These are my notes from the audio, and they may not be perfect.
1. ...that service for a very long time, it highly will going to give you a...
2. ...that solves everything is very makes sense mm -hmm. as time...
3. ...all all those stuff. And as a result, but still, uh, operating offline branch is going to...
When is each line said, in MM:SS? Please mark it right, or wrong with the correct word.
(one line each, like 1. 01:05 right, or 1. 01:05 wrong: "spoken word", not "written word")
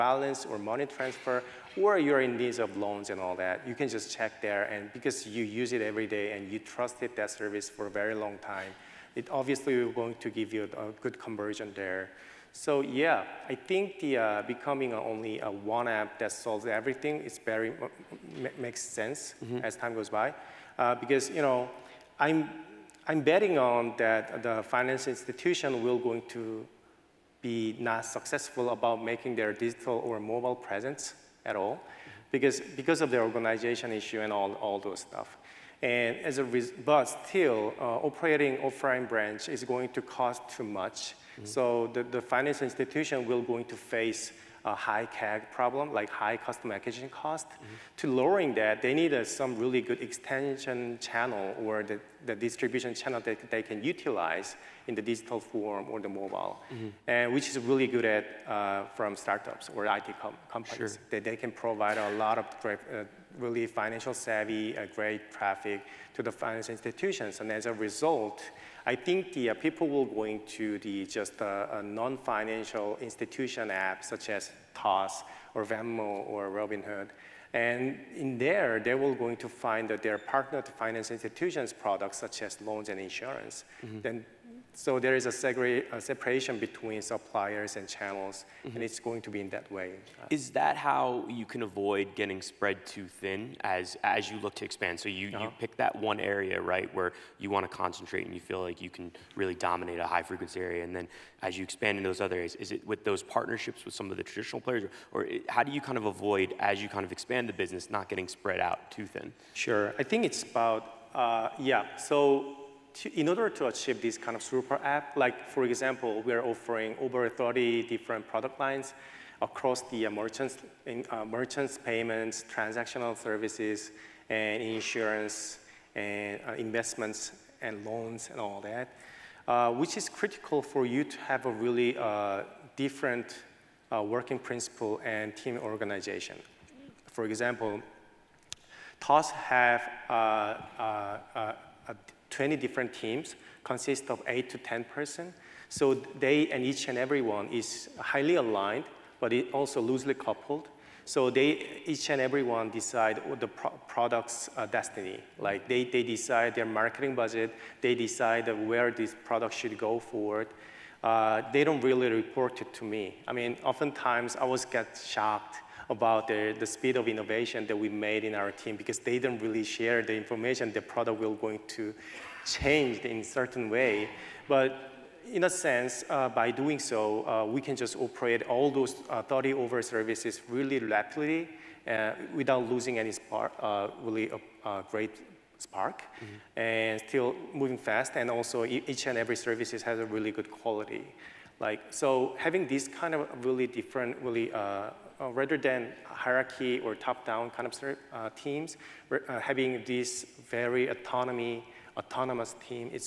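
1. 00:07 wrong: "obviously", not "highly"
2. 00:16 right
3. 00:34 right.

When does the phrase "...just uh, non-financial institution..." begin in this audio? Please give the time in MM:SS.
01:11.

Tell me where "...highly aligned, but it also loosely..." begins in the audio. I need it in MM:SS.
02:27.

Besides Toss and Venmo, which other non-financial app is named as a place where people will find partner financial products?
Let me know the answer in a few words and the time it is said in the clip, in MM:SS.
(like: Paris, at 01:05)
Robinhood, at 01:16.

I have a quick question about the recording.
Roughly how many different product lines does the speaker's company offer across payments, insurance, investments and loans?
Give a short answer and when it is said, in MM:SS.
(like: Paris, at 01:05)
Over 30, at 01:57.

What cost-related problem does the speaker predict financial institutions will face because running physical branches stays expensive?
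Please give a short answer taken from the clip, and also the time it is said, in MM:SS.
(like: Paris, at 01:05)
High customer acquisition cost, at 00:46.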